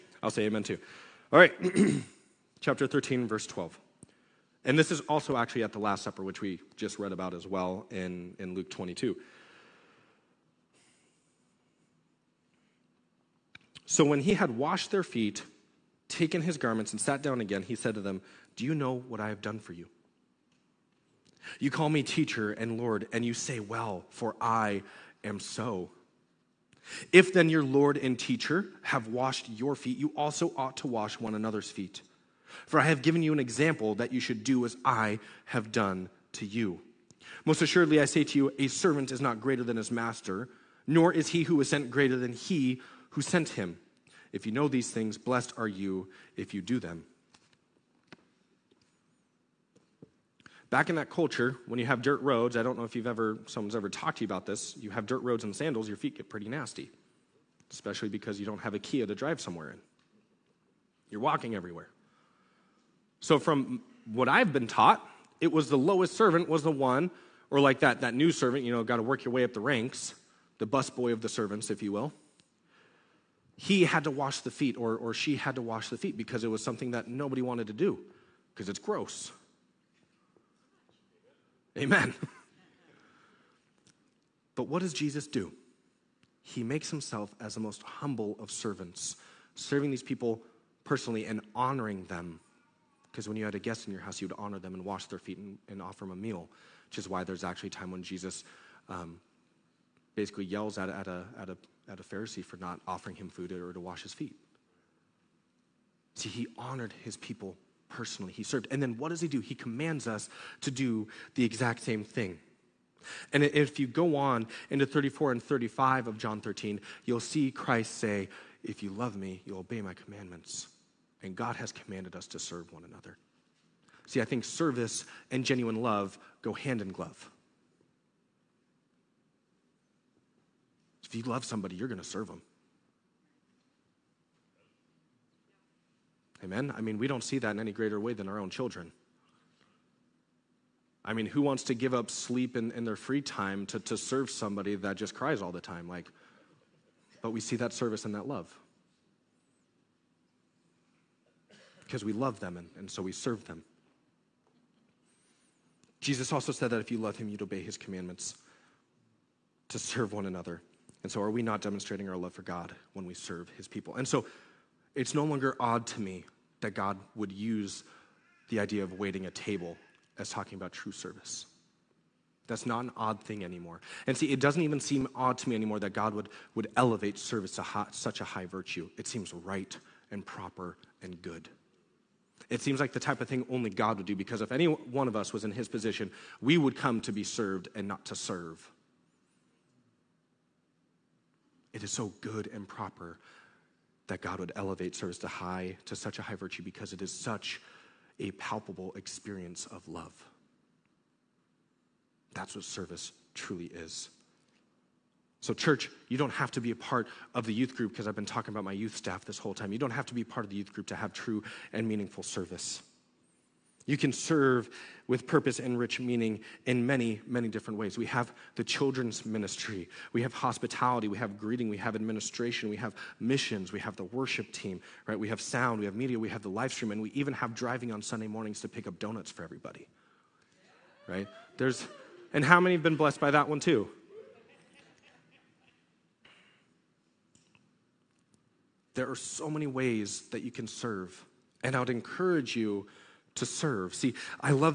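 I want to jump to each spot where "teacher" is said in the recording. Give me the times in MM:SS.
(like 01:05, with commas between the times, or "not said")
00:22, 00:28.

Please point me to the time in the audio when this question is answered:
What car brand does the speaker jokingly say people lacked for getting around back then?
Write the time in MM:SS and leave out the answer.
00:58.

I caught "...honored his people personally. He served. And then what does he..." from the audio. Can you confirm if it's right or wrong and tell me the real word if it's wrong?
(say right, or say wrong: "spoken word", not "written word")
right.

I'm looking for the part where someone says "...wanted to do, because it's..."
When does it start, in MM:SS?
01:17.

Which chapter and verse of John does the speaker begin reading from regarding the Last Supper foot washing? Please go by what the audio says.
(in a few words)
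13:12.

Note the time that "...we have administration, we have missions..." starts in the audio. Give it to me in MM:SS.
03:41.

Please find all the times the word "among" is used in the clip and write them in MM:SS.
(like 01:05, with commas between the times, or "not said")
not said.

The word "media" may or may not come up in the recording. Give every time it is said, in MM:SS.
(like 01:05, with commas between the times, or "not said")
03:45.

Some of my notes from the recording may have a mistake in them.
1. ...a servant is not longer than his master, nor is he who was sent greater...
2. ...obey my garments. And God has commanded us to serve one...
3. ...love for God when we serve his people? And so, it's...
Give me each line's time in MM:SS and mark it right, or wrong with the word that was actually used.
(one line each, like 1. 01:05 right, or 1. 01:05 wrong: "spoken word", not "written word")
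1. 00:38 wrong: "greater", not "longer"
2. 01:59 wrong: "commandments", not "garments"
3. 02:42 right.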